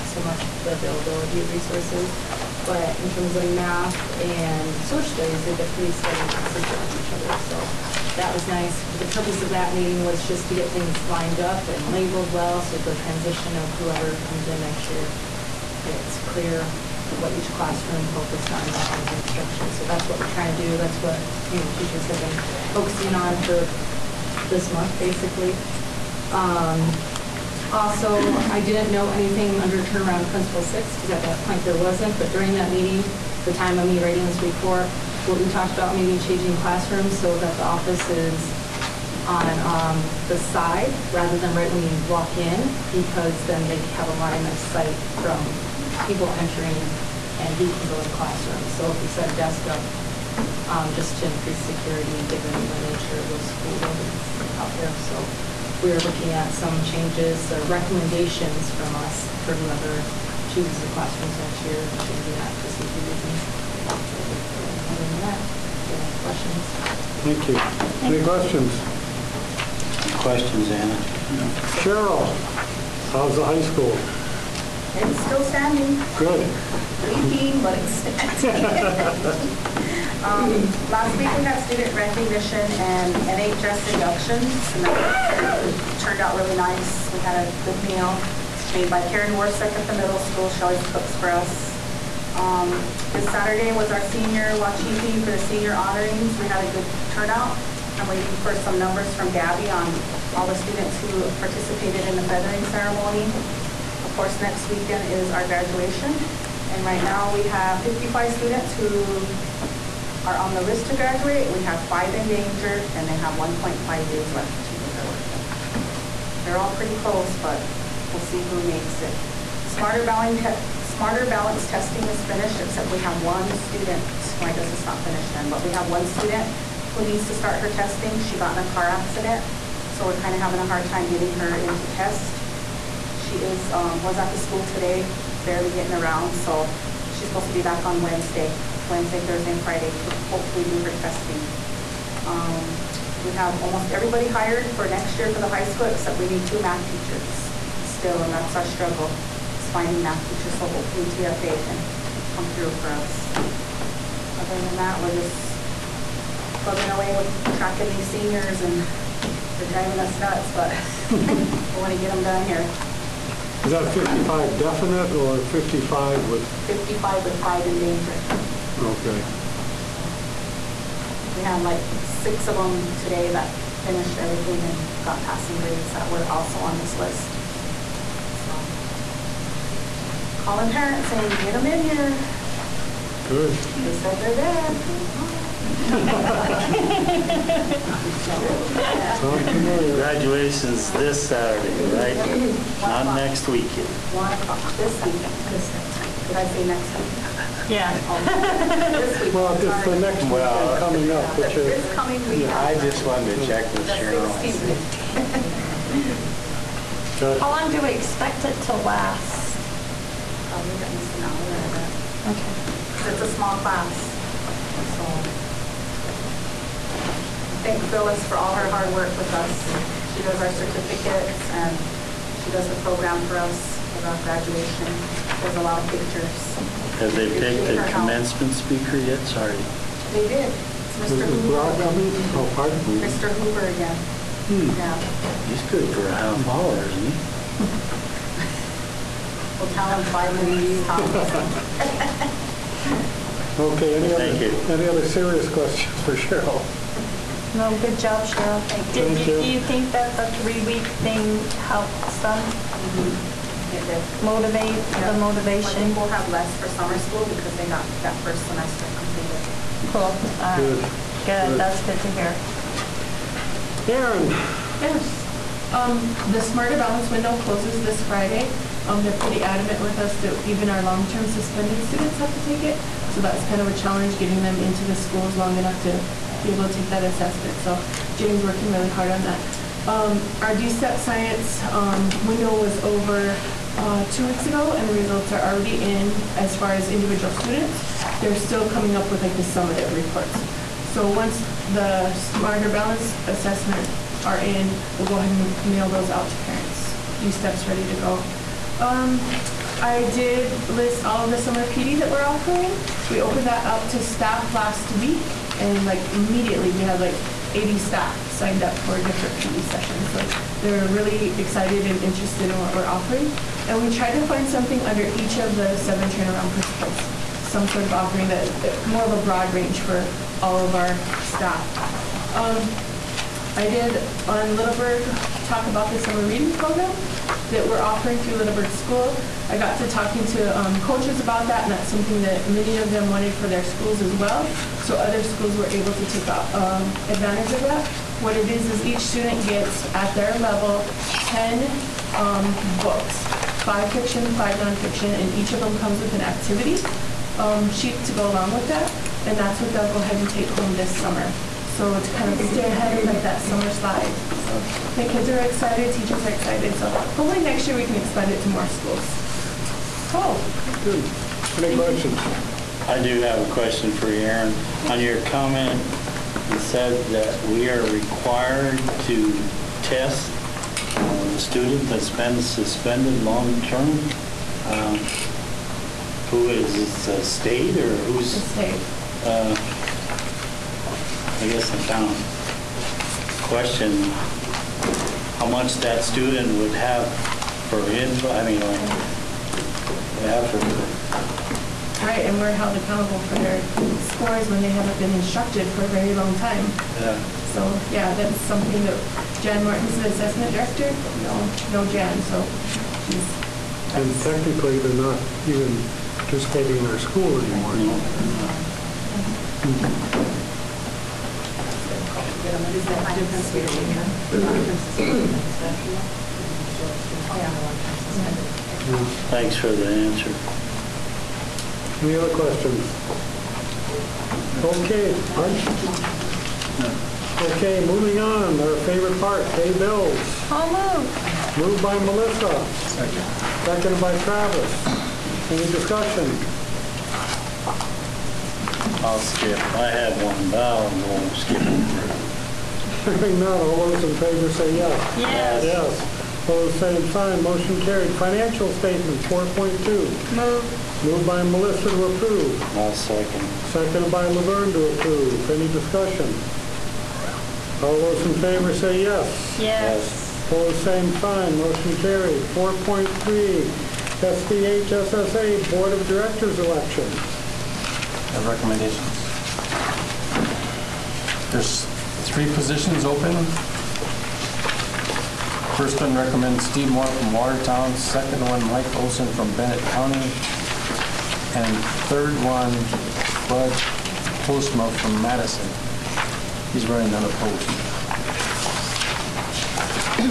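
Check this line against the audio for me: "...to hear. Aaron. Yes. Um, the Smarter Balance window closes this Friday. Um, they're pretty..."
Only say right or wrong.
right.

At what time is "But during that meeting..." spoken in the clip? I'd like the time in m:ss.
0:32.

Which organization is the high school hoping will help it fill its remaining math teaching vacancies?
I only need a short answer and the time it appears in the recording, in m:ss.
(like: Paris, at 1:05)
TFA, at 2:31.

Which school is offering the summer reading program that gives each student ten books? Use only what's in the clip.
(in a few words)
Littleburg School.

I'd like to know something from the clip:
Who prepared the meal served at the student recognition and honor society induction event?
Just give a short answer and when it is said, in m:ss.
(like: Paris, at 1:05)
Karen Warsick, at 1:29.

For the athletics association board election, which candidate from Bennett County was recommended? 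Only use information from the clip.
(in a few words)
Mike Olson.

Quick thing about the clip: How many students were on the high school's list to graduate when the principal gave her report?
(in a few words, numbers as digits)
55.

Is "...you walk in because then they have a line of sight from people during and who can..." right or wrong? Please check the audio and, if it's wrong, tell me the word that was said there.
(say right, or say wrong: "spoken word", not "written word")
wrong: "entering", not "during".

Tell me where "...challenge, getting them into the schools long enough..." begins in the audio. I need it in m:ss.
4:33.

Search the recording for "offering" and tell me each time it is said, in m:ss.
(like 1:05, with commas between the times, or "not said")
5:02, 5:12, 5:17, 5:27.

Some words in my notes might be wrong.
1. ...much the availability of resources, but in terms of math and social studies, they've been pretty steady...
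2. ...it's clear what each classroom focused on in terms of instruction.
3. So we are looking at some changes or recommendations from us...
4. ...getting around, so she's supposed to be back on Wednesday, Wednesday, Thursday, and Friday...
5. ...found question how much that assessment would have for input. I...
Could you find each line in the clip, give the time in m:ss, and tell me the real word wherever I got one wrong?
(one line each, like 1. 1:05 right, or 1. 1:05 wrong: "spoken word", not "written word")
1. 0:00 right
2. 0:15 right
3. 0:54 right
4. 2:15 right
5. 6:21 wrong: "student", not "assessment".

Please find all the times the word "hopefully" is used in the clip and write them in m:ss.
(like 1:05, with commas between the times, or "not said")
2:20, 2:30, 5:56.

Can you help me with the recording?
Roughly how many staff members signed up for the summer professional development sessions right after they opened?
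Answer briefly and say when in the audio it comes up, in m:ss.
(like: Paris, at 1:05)
80, at 5:07.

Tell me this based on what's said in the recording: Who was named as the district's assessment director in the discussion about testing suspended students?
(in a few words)
Jan Martin.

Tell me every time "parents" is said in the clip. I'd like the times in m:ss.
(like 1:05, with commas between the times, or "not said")
3:00, 4:56.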